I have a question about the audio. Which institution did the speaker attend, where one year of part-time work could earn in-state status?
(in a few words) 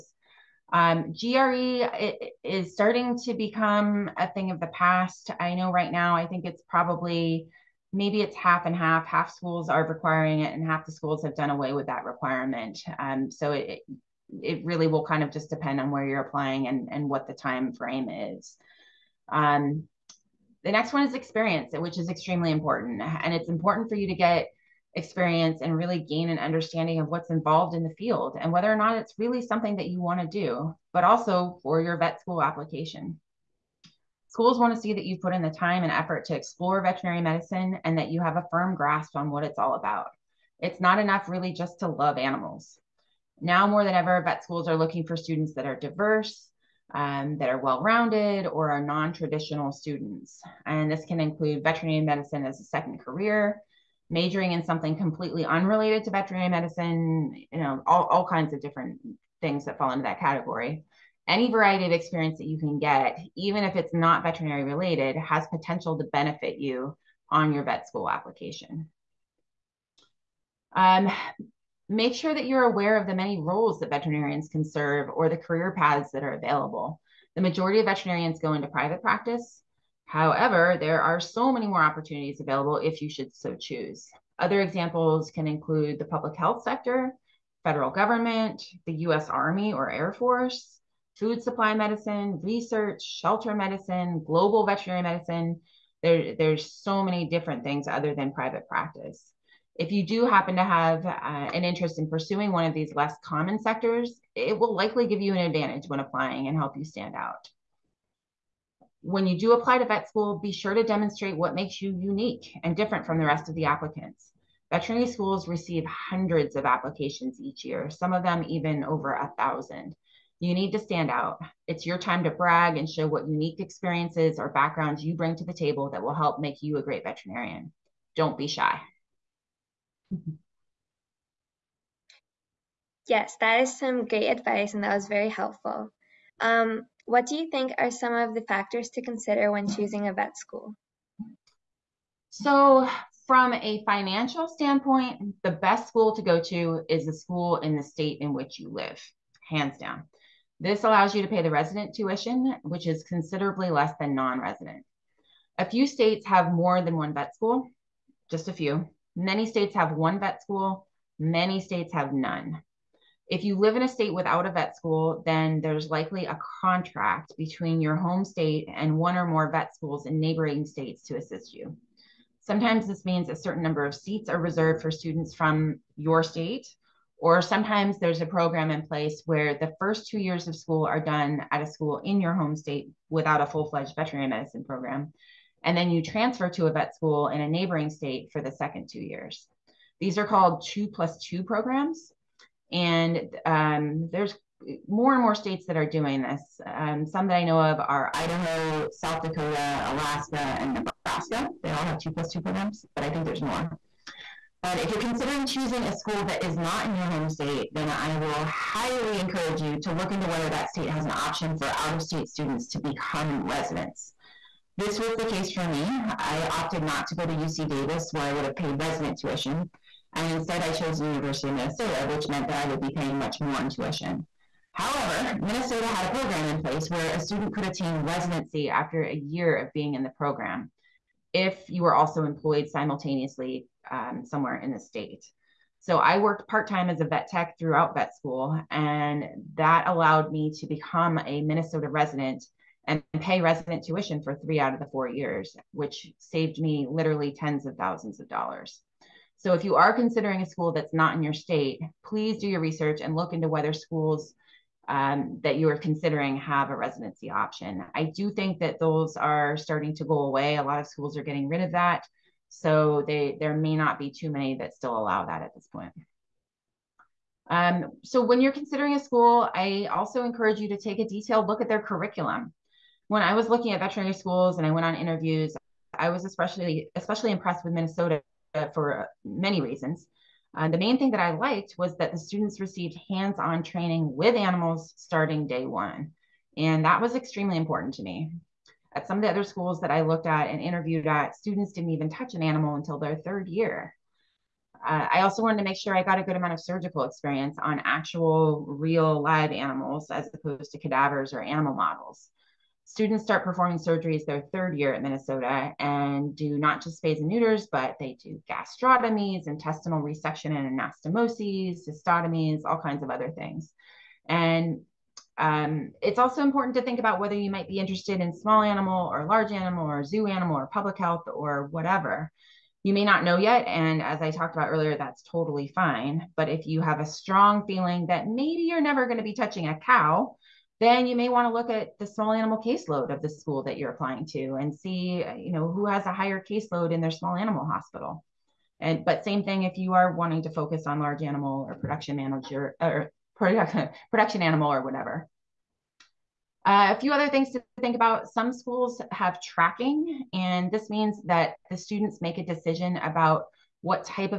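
University of Minnesota.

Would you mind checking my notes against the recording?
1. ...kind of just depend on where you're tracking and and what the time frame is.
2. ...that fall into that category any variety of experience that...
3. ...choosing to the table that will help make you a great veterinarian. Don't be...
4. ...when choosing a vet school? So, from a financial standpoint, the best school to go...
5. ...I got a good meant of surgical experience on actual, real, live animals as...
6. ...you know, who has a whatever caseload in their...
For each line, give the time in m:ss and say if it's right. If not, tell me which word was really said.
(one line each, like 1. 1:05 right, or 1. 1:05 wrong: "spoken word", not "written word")
1. 0:15 wrong: "applying", not "tracking"
2. 0:59 right
3. 2:05 wrong: "bring", not "choosing"
4. 2:19 right
5. 4:55 wrong: "amount", not "meant"
6. 5:35 wrong: "higher", not "whatever".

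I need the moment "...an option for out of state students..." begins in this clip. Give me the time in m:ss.
3:31.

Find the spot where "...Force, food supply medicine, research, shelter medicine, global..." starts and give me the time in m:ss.
1:30.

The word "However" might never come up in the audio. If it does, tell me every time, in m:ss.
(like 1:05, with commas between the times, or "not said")
1:20, 3:44.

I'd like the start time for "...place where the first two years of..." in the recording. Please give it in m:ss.
2:58.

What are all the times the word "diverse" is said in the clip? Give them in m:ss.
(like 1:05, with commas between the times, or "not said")
0:45.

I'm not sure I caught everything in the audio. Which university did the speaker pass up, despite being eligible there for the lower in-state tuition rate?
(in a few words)
UC Davis.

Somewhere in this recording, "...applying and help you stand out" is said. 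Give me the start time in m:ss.
1:45.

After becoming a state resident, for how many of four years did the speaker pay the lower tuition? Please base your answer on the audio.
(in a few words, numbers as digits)
3.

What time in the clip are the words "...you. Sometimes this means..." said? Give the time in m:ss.
2:51.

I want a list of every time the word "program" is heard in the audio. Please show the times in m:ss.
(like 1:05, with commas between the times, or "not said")
2:58, 3:04, 3:11, 3:22, 3:46, 3:50.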